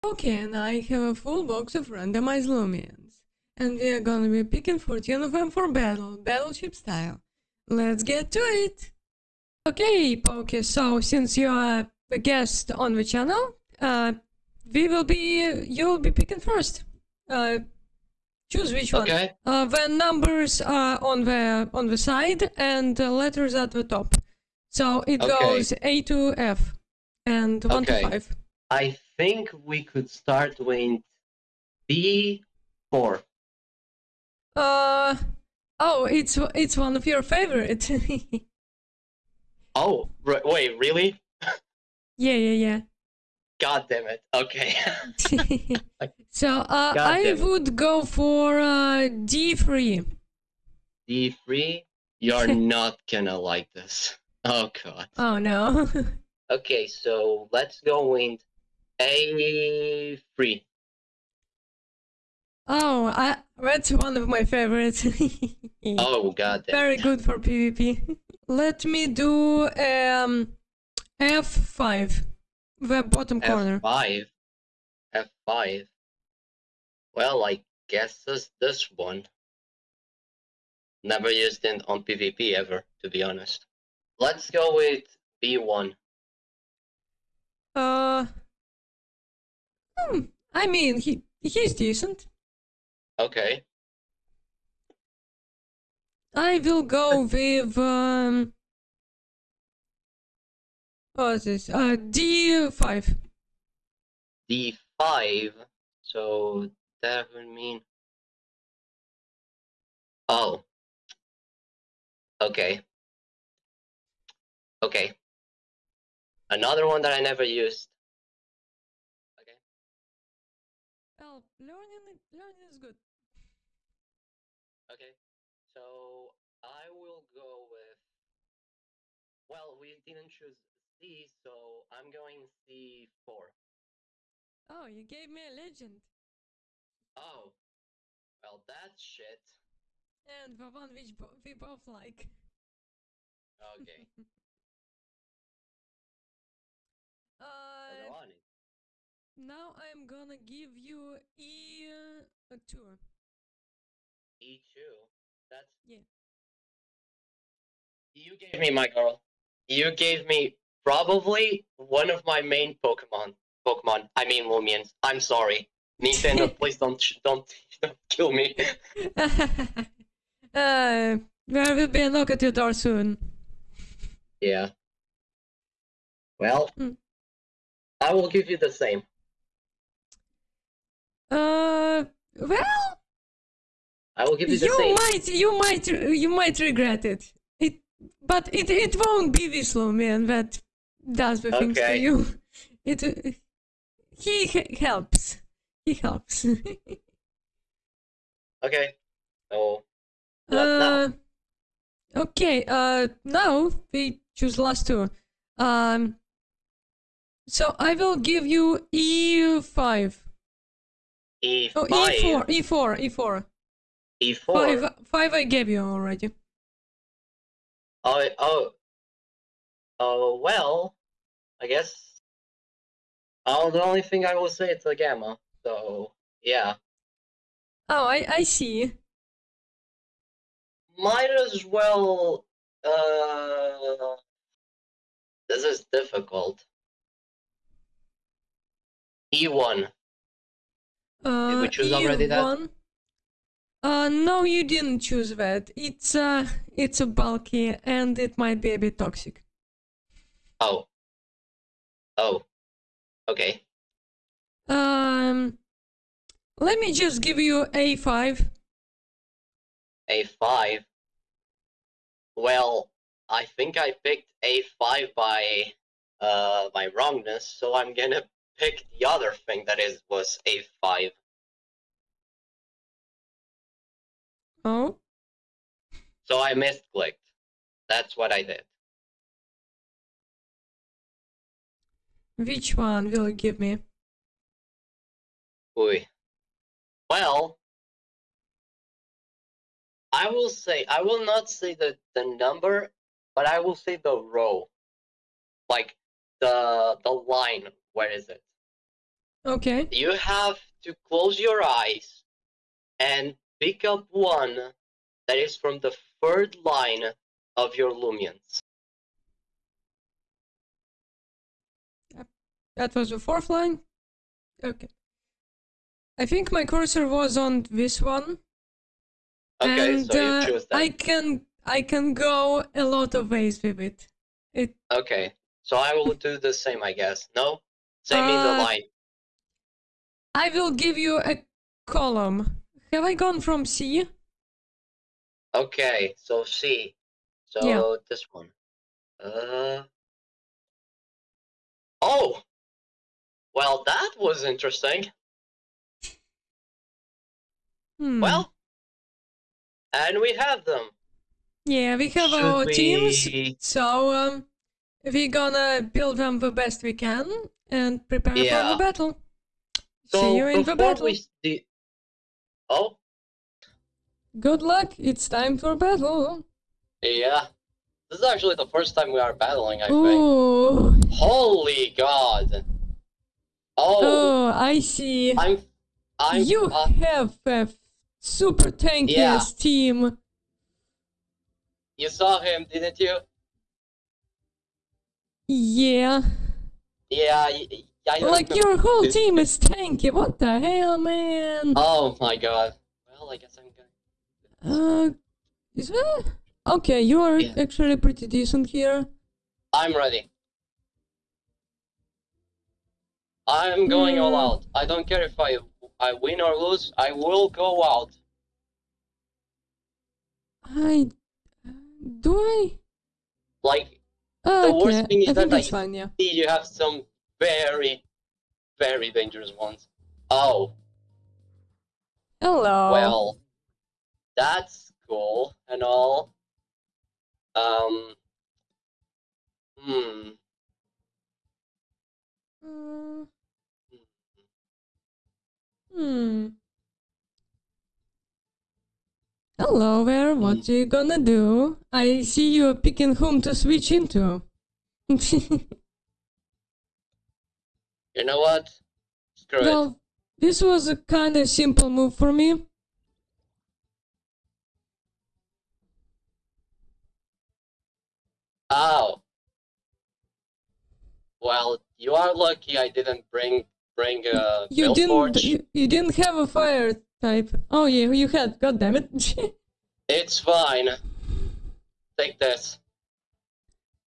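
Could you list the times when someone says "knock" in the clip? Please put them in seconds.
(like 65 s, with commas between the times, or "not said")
172 s.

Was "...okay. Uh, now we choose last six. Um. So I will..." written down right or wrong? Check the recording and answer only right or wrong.
wrong.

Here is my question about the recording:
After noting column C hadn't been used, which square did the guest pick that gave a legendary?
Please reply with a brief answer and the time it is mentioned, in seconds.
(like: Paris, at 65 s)
C4, at 132 s.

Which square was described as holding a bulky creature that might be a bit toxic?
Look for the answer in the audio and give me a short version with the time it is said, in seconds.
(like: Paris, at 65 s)
E1, at 239 s.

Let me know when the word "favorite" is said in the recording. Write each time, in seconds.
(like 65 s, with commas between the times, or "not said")
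37 s, 64 s.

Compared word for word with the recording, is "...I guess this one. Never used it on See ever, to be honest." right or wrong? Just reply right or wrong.
wrong.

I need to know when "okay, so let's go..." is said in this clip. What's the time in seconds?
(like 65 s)
56 s.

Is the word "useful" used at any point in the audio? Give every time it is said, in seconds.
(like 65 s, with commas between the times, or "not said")
not said.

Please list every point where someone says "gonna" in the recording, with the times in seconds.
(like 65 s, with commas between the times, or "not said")
4 s, 53 s, 150 s, 267 s, 355 s, 440 s.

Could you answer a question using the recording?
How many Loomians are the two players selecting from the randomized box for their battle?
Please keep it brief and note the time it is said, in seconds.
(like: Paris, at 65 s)
14, at 4 s.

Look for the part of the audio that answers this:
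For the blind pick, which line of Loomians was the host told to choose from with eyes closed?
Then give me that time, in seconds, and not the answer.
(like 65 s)
306 s.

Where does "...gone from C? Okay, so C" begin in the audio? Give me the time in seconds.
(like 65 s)
333 s.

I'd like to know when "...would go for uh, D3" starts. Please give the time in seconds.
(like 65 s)
47 s.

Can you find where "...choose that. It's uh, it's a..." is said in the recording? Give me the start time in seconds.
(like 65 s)
245 s.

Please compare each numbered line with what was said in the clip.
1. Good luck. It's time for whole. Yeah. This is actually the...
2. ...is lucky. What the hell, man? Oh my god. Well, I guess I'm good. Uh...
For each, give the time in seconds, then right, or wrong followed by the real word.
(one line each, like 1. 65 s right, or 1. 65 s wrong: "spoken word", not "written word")
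1. 364 s wrong: "battle", not "whole"
2. 389 s wrong: "tanky", not "lucky".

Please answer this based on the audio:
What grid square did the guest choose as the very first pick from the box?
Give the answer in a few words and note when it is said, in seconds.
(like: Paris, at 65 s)
B4, at 31 s.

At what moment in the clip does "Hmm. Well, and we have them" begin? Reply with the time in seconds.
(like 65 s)
348 s.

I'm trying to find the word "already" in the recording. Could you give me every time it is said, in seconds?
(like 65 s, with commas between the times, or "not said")
215 s, 241 s.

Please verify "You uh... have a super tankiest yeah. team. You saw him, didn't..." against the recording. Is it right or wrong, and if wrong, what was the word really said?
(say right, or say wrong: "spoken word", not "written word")
right.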